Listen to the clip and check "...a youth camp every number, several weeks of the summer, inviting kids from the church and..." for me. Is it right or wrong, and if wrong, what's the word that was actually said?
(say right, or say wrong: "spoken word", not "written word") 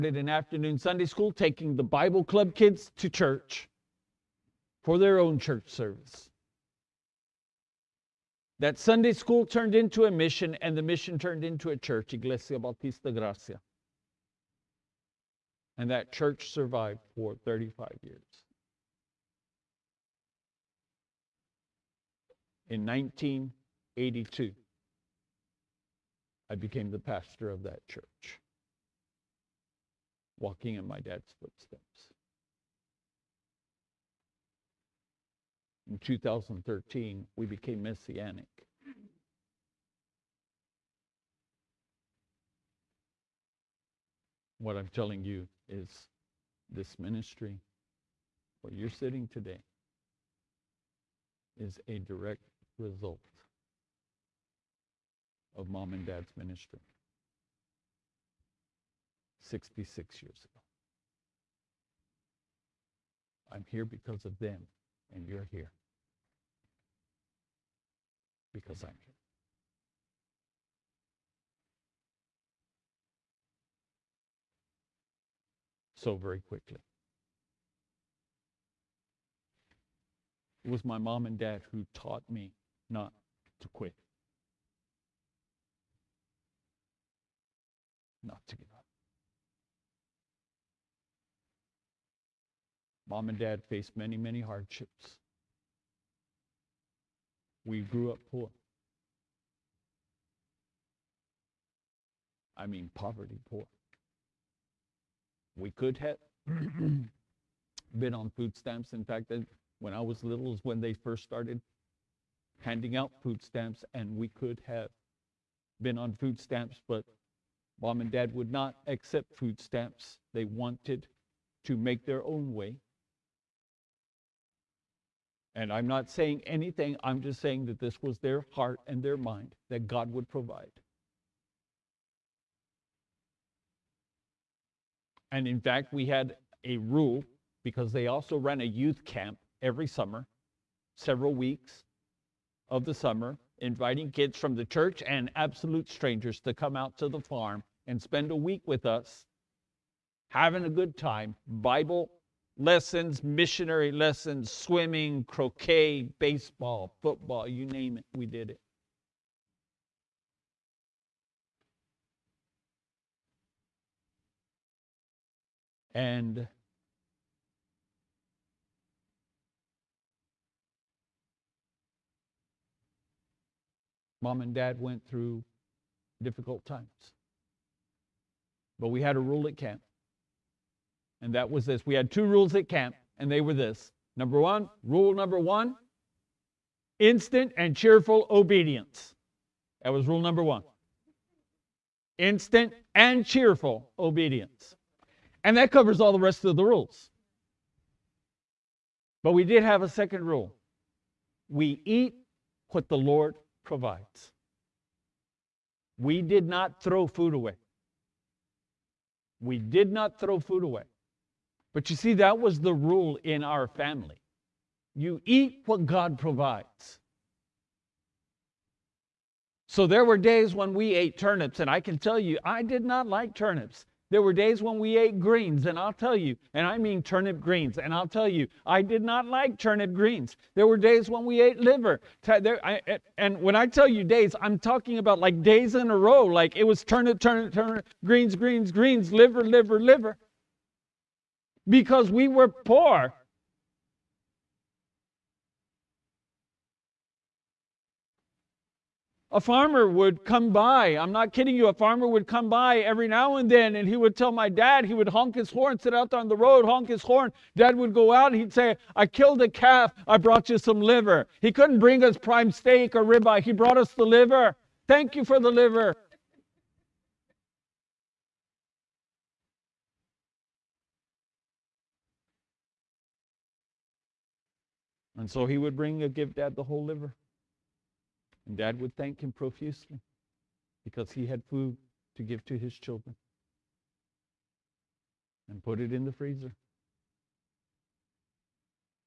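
wrong: "summer", not "number".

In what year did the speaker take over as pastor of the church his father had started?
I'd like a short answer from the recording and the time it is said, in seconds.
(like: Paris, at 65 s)
1982, at 22 s.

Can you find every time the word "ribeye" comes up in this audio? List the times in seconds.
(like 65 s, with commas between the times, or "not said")
263 s.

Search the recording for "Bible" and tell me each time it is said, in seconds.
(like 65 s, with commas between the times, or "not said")
1 s, 151 s.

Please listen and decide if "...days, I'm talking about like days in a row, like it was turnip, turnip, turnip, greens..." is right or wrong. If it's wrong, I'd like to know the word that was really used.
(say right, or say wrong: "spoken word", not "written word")
right.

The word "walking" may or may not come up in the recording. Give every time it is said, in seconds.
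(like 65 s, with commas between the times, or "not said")
30 s.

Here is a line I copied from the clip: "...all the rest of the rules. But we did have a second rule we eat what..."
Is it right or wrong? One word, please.
right.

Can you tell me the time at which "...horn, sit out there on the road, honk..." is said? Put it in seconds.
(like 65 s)
255 s.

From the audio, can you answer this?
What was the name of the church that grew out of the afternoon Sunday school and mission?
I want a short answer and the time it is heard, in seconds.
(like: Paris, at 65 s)
Iglesia Bautista Gracia, at 12 s.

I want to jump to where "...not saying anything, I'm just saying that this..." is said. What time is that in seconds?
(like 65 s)
125 s.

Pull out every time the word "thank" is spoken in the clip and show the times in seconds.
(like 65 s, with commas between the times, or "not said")
264 s, 278 s.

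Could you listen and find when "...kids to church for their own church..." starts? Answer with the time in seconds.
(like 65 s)
2 s.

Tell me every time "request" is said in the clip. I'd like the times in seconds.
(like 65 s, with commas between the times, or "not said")
not said.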